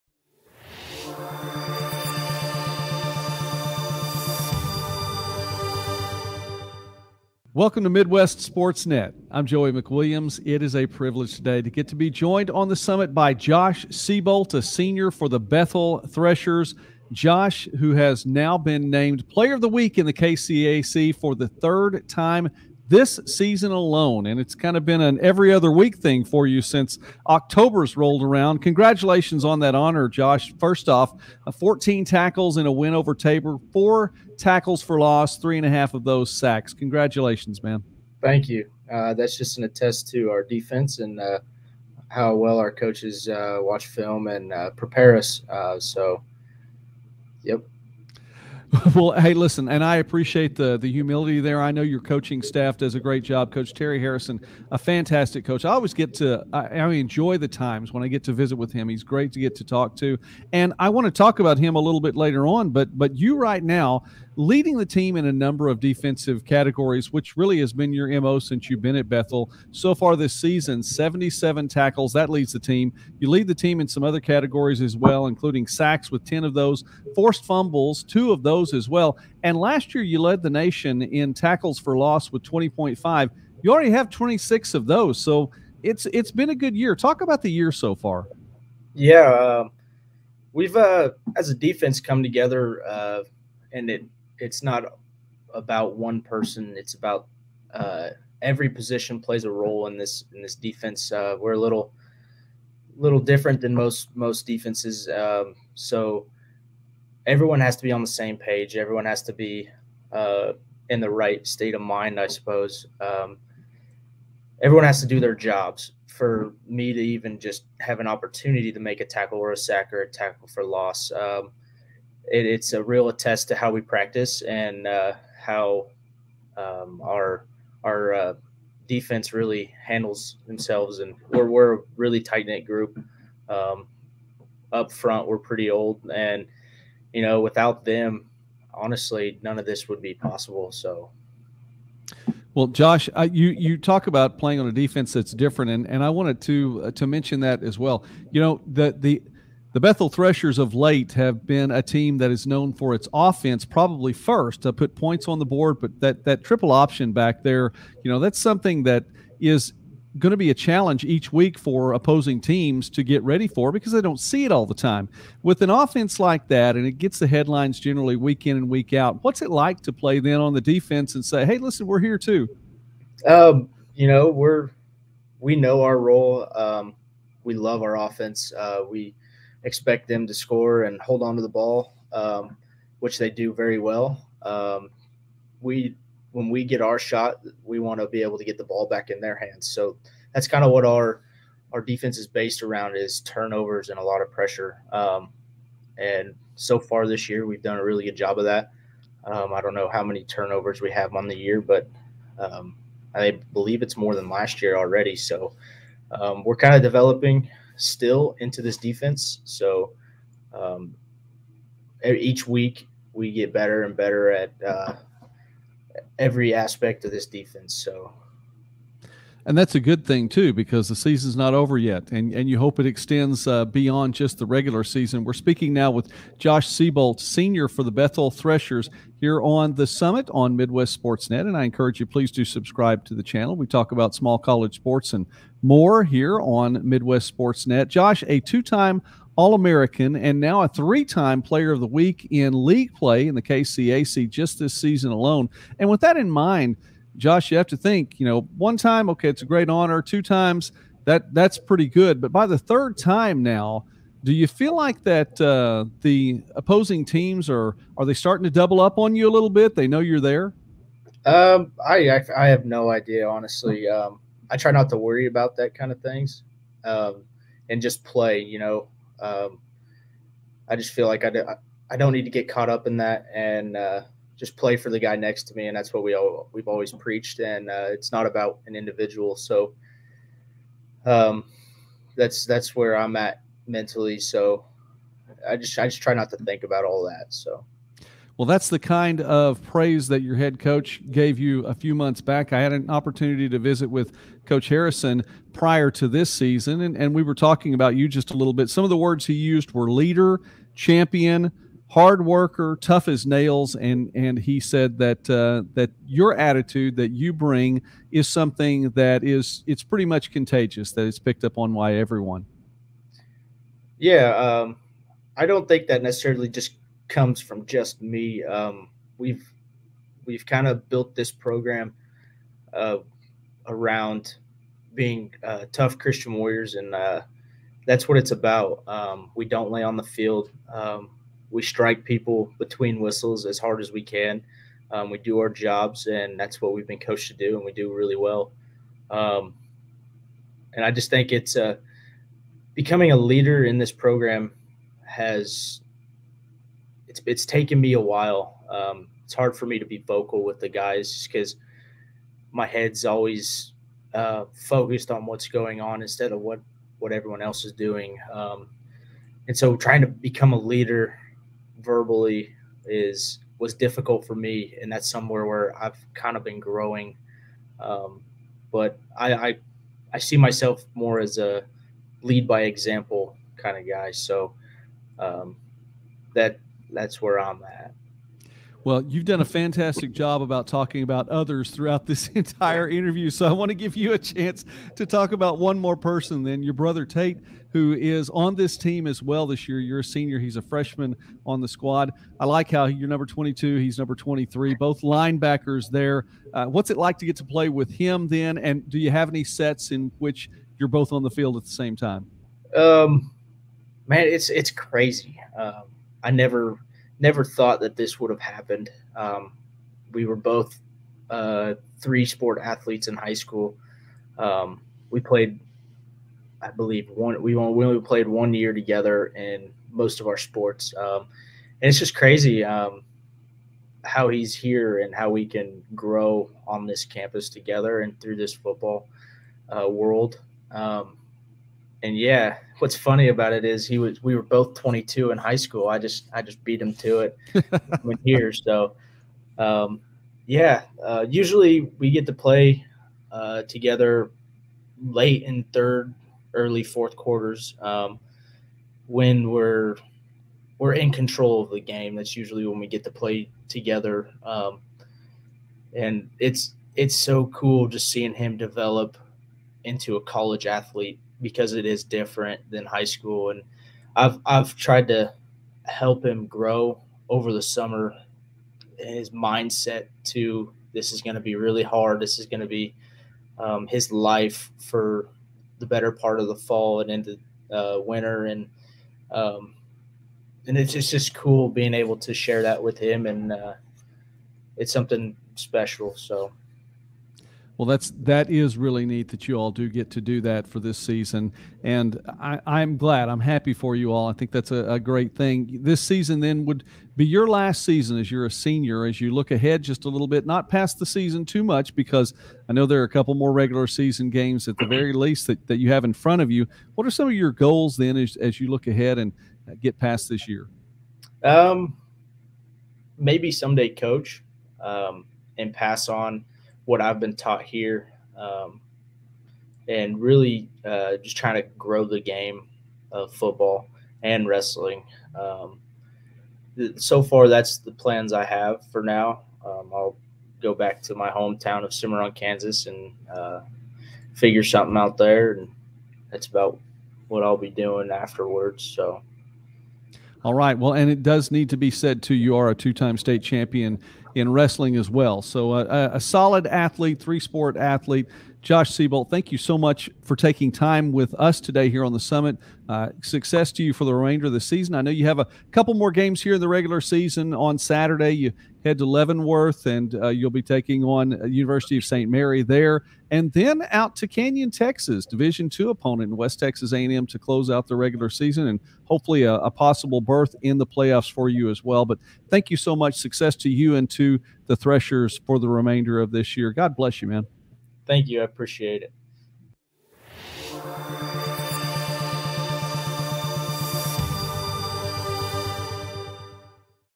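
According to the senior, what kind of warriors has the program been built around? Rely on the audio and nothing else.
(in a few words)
Tough Christian warriors.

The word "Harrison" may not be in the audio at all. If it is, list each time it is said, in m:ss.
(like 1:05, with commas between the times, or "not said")
0:53, 4:54.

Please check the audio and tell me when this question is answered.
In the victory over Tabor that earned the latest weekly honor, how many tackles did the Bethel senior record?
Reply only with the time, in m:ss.
0:31.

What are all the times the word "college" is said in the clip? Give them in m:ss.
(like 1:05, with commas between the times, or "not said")
3:54, 7:40.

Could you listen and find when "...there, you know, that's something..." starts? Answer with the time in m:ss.
2:37.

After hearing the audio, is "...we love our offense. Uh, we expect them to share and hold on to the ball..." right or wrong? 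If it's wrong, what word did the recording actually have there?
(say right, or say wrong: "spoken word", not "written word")
wrong: "score", not "share".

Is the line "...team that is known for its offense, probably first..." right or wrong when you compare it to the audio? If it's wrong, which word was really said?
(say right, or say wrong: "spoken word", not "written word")
right.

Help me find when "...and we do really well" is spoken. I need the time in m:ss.
5:37.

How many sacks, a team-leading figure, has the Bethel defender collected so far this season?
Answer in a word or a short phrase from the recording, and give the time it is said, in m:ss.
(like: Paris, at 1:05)
10, at 1:16.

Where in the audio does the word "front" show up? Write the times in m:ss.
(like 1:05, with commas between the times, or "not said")
2:14, 8:26.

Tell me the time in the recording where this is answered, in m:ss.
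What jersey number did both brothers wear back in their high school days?
7:14.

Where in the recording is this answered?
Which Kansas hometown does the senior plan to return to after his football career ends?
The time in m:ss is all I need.
8:51.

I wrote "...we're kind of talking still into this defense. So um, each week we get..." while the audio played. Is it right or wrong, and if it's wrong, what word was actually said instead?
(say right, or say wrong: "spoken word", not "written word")
wrong: "developing", not "talking".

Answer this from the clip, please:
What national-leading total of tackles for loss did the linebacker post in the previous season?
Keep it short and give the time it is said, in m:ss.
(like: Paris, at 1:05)
20.5, at 1:22.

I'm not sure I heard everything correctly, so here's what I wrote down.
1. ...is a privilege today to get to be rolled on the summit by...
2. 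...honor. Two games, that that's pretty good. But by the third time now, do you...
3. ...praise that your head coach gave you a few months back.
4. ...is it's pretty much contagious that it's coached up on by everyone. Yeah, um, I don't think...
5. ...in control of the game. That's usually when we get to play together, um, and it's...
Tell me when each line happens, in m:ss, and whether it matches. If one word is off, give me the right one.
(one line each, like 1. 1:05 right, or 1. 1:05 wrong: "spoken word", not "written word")
1. 0:10 wrong: "joined", not "rolled"
2. 4:09 wrong: "times", not "games"
3. 4:49 right
4. 5:09 wrong: "picked", not "coached"
5. 7:30 right.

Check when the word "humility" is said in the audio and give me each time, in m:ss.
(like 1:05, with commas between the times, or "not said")
0:50.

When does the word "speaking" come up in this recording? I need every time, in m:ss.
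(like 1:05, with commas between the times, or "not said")
3:45.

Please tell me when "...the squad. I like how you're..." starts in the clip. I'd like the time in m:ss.
6:31.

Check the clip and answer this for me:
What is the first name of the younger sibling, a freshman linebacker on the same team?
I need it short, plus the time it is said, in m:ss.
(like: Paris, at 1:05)
Tate, at 6:27.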